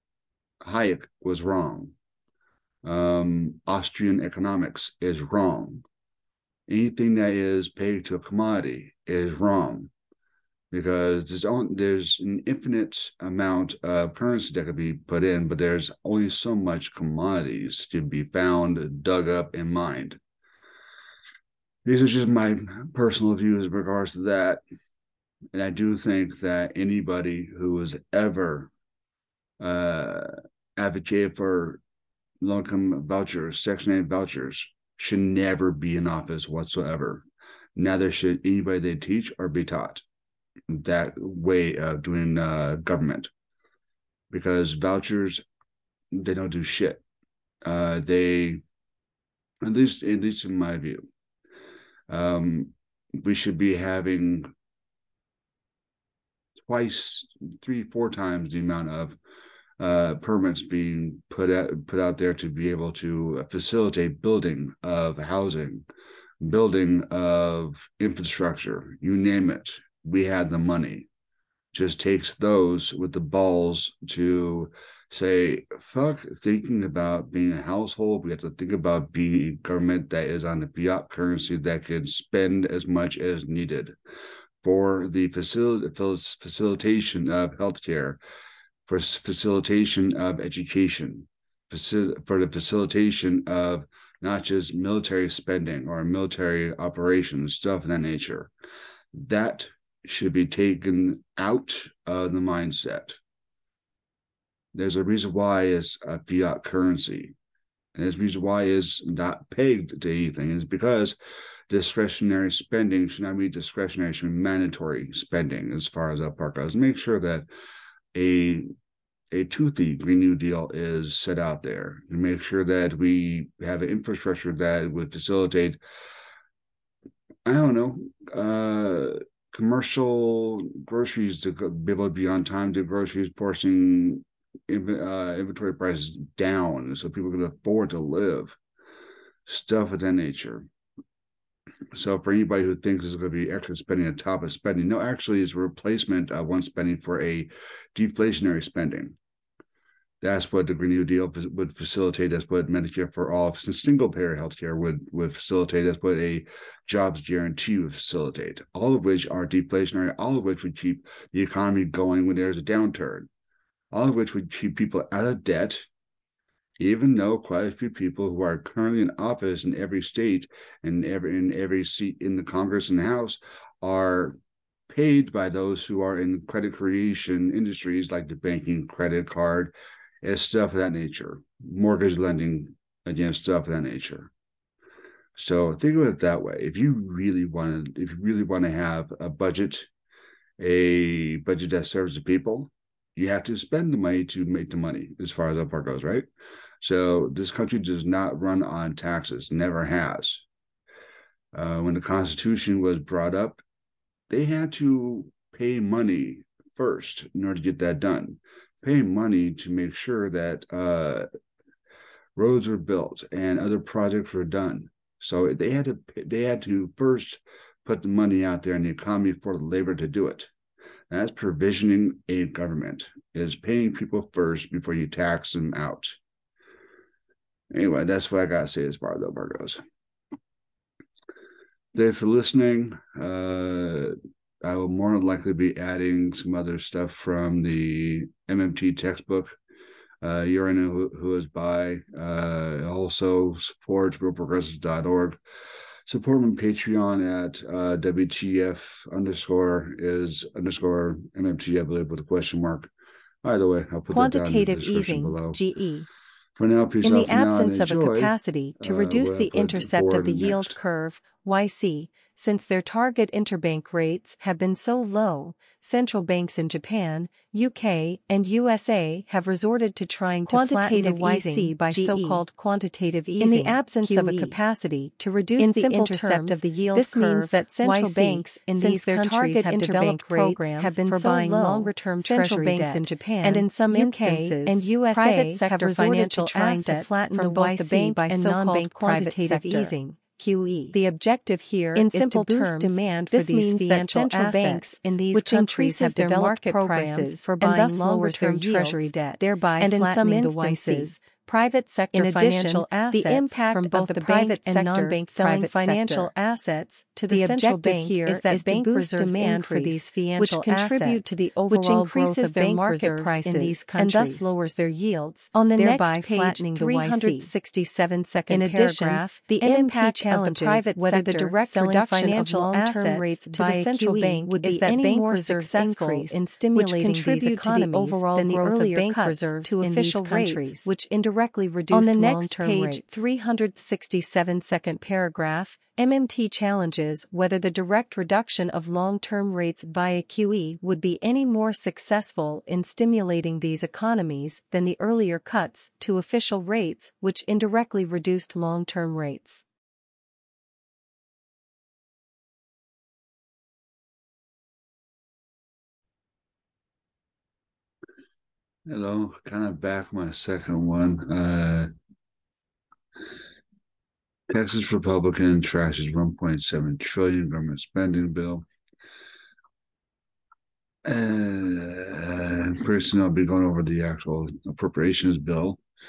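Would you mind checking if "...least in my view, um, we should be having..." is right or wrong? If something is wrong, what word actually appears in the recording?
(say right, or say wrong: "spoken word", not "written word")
right.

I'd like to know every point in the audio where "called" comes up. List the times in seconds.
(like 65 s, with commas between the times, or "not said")
271 s, 288 s.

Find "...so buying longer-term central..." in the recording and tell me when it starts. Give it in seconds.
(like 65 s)
281 s.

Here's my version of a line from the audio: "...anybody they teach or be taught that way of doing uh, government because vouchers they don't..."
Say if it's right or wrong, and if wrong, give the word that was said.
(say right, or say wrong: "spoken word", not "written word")
right.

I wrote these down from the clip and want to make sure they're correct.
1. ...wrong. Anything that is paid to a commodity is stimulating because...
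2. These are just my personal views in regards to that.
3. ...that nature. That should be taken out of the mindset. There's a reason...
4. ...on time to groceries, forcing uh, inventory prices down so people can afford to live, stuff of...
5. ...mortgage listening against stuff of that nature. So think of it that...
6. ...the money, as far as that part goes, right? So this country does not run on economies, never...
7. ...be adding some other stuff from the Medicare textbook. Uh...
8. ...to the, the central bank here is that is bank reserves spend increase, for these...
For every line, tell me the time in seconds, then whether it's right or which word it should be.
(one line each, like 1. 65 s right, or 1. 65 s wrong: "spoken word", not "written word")
1. 5 s wrong: "wrong", not "stimulating"
2. 21 s right
3. 97 s right
4. 132 s right
5. 181 s wrong: "lending", not "listening"
6. 194 s wrong: "taxes", not "economies"
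7. 235 s wrong: "MMT", not "Medicare"
8. 307 s wrong: "demand", not "spend".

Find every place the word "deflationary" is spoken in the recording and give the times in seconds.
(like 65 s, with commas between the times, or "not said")
147 s, 159 s.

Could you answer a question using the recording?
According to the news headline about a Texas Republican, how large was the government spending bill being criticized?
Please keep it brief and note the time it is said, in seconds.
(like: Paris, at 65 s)
1.7 trillion, at 366 s.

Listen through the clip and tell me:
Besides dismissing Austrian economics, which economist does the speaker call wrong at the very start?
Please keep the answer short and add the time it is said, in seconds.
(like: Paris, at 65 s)
Hayek, at 0 s.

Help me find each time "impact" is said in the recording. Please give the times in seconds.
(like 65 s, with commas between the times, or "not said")
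303 s, 319 s.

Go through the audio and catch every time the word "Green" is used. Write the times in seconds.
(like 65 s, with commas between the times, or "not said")
119 s, 150 s.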